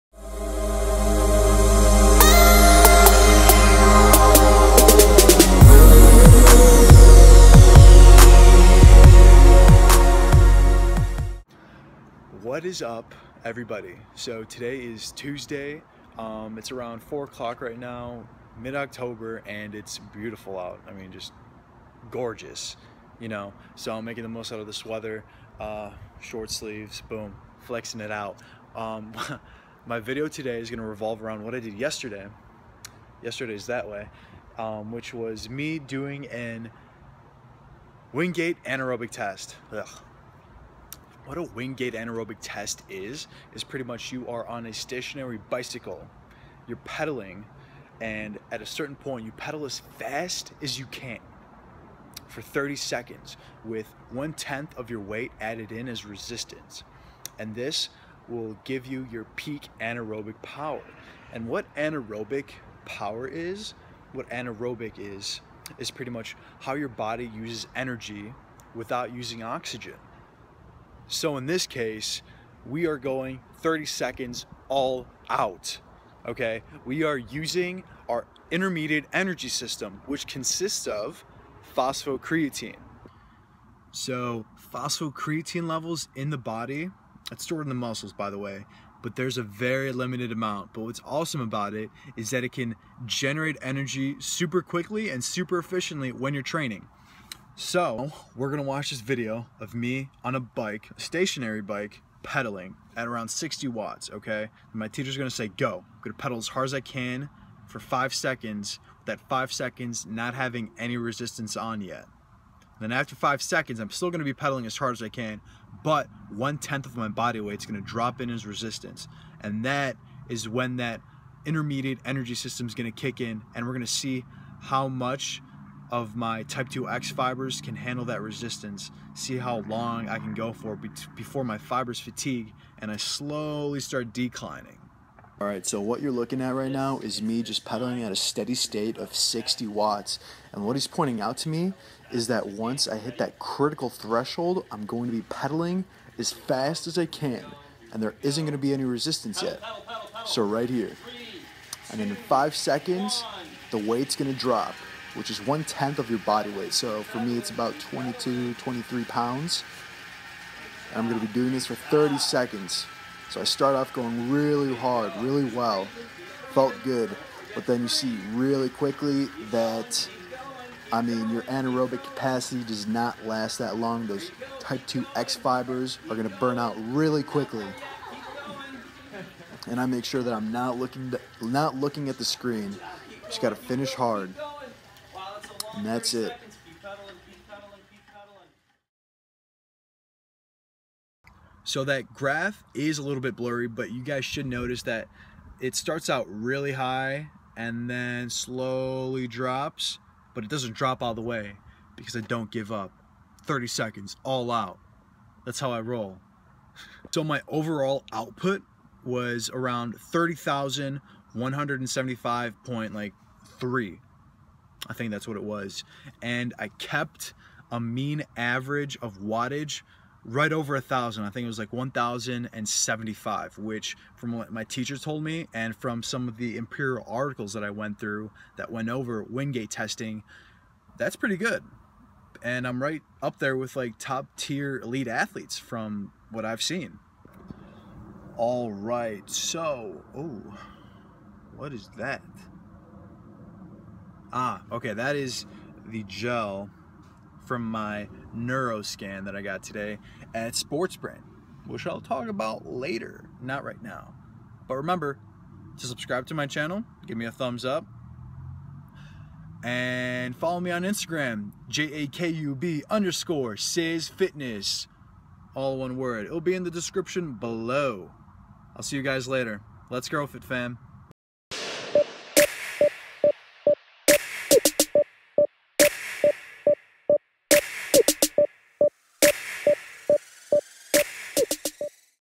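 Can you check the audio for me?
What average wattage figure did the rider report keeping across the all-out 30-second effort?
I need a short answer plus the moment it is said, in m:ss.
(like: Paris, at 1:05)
1,075, at 3:41.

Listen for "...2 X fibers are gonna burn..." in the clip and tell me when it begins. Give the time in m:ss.
2:54.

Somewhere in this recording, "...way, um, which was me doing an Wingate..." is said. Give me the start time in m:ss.
0:33.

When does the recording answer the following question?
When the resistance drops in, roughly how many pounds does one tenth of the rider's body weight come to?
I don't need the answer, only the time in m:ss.
2:37.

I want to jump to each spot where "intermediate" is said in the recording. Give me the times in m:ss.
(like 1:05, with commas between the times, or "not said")
1:18, 2:01.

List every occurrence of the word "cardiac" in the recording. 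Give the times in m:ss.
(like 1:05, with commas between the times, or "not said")
not said.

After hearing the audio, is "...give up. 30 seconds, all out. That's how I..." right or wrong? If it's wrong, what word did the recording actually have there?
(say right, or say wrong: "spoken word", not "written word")
right.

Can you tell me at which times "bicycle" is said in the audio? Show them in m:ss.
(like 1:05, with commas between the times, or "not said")
0:45.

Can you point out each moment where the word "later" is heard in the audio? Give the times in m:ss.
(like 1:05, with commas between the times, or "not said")
4:12, 4:29.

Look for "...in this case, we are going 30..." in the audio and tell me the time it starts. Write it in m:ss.
1:11.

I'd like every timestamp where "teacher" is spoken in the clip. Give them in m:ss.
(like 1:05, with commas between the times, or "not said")
1:44, 3:44.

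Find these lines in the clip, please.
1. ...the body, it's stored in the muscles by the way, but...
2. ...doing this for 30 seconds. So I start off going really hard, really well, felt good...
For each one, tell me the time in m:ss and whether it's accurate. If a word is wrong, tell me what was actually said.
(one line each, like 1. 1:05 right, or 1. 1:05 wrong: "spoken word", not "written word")
1. 1:26 right
2. 2:41 right.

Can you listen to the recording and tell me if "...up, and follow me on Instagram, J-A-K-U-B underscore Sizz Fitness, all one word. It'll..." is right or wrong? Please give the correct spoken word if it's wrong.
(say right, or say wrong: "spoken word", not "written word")
right.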